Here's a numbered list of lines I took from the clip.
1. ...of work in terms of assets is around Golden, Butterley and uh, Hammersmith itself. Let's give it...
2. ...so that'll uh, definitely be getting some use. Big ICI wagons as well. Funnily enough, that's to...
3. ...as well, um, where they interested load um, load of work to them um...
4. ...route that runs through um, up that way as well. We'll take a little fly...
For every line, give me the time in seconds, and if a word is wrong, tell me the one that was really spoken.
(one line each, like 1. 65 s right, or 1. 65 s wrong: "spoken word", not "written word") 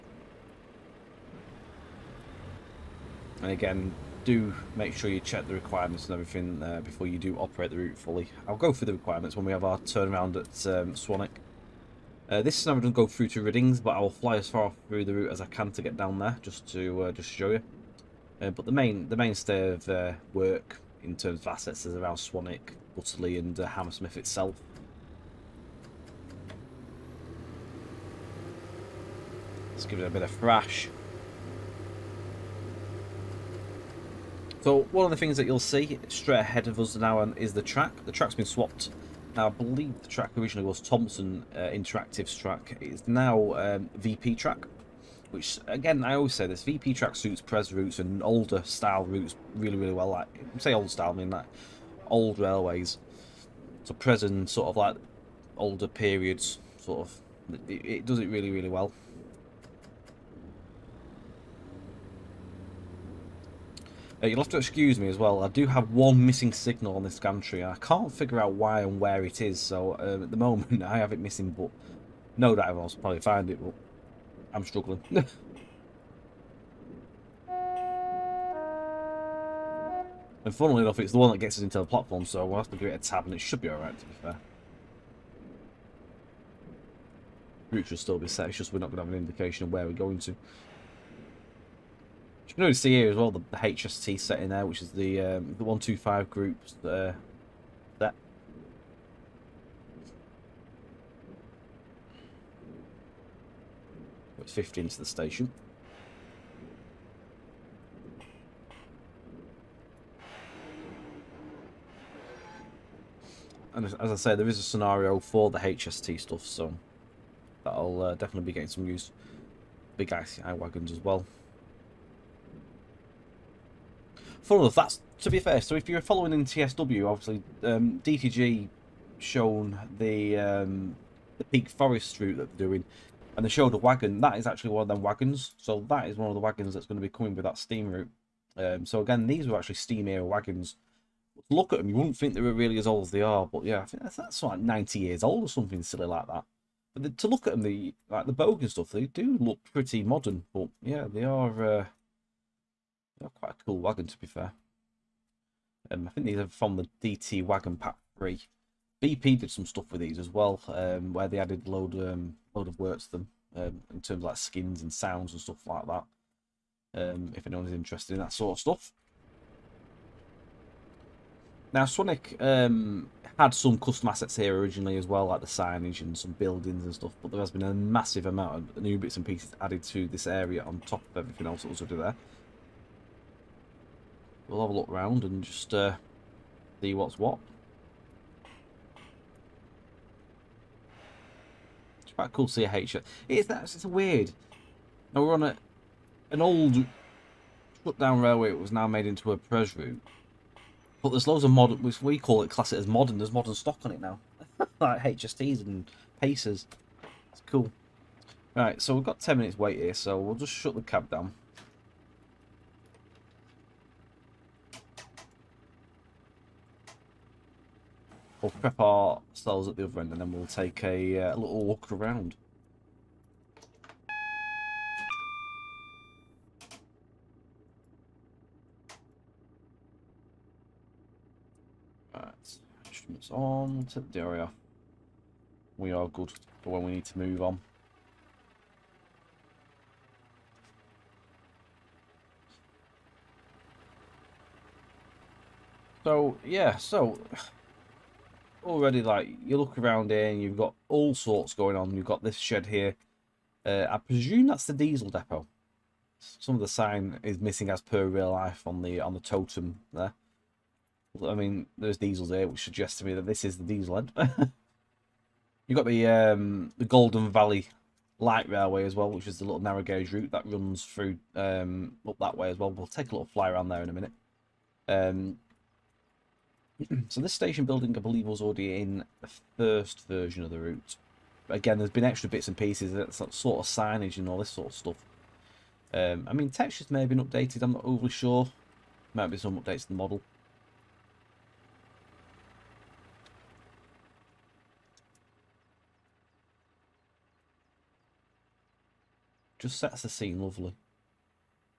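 1. 19 s wrong: "Swanwick", not "Golden"
2. 116 s right
3. 160 s wrong: "added", not "interested"
4. 270 s right.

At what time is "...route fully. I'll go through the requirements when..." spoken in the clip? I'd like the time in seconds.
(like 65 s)
7 s.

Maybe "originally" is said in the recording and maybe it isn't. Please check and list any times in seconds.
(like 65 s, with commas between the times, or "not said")
40 s, 174 s.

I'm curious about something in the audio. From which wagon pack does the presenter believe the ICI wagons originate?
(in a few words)
DT Wagon Pack 3.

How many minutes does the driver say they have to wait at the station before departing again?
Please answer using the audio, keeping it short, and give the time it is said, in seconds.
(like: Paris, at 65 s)
10, at 209 s.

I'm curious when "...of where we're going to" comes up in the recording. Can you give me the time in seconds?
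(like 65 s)
89 s.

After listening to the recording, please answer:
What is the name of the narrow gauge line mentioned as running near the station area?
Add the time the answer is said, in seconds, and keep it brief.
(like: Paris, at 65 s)
Golden Valley Light Railway, at 266 s.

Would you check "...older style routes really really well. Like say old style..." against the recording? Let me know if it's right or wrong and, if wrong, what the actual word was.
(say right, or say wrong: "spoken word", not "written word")
right.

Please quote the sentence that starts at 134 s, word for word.
That is actually one of them wagons.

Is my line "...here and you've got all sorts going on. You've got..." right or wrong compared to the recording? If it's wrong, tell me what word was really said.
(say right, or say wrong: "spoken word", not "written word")
right.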